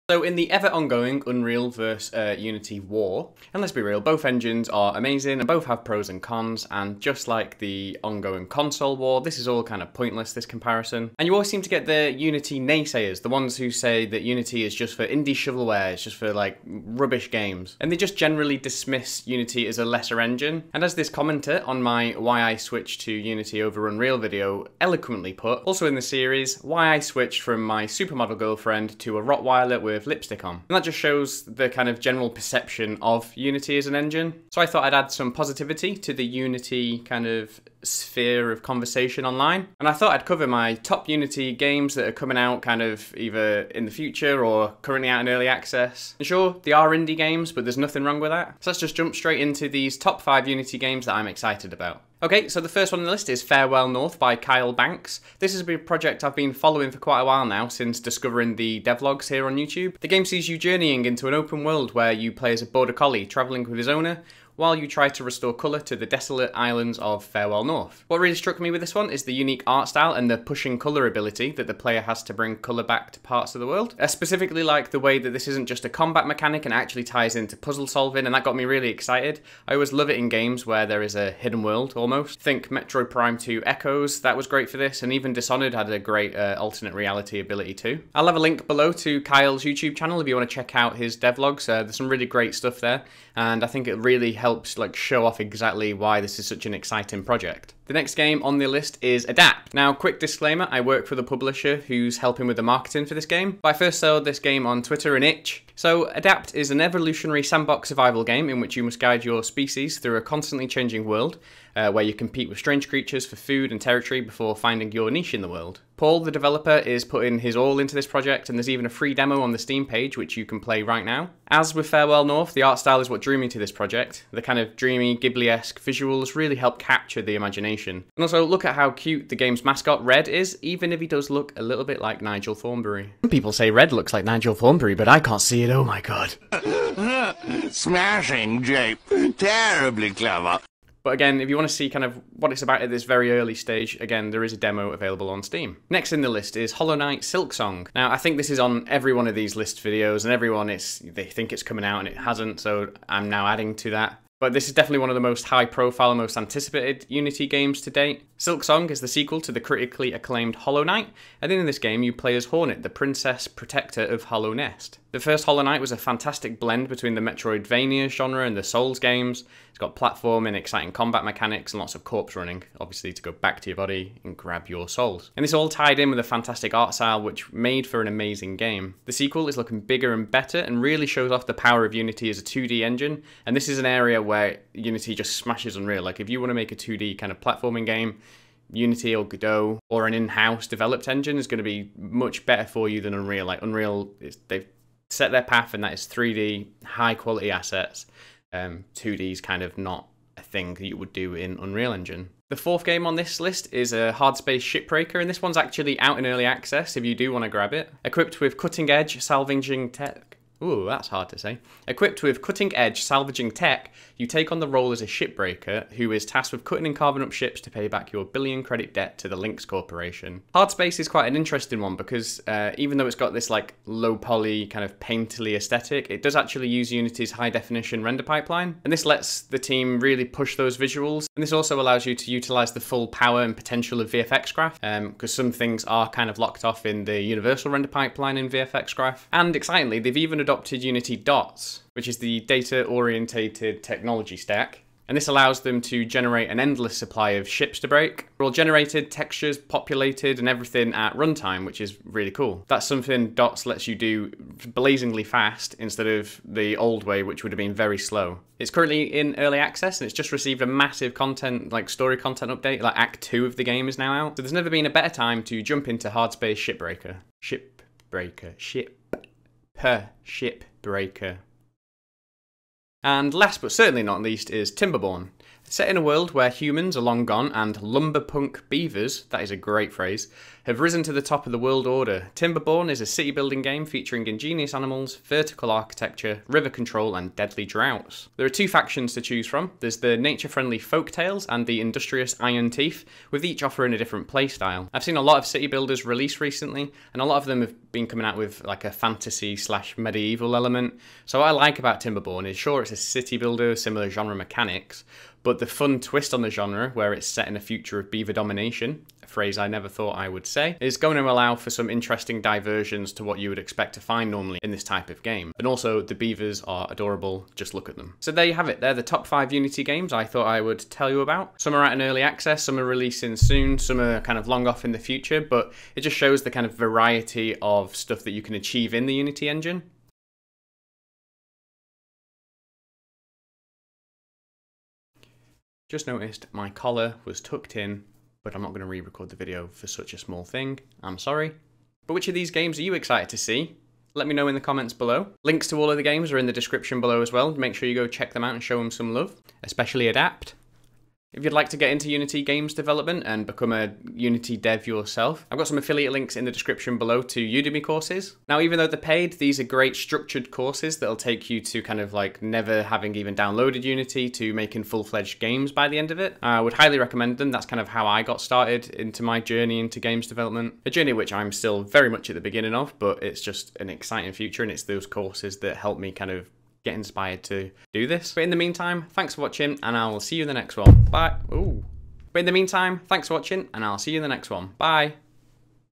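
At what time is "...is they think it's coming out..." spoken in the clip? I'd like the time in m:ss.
2:30.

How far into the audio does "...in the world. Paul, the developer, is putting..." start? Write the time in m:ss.
1:55.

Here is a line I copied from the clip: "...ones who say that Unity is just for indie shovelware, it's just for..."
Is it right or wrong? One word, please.
right.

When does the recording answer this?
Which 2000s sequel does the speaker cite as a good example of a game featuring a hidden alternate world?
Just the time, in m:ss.
1:22.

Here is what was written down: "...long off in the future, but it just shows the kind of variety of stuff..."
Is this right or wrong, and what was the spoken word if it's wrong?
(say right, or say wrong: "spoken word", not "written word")
right.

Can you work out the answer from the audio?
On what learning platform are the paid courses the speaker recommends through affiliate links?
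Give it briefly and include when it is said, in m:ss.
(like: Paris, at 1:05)
Udemy, at 5:57.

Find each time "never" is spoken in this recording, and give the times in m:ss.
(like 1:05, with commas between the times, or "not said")
4:24, 5:09, 6:02.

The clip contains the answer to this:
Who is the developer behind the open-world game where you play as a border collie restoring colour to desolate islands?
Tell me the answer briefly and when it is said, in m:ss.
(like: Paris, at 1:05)
Kyle Banks, at 0:54.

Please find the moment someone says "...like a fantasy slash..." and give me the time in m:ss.
4:58.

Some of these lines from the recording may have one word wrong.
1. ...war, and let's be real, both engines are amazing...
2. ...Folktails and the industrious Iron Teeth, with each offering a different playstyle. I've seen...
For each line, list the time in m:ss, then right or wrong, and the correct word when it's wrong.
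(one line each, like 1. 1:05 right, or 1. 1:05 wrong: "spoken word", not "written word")
1. 0:02 right
2. 4:50 right.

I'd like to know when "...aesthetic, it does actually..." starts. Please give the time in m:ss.
3:45.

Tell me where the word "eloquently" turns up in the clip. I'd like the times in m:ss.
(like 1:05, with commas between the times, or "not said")
0:24.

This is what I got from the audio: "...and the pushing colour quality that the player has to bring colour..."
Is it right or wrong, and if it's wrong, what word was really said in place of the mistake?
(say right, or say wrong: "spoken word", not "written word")
wrong: "ability", not "quality".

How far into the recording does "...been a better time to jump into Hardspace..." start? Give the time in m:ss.
4:24.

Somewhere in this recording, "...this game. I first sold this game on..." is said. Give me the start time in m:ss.
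1:43.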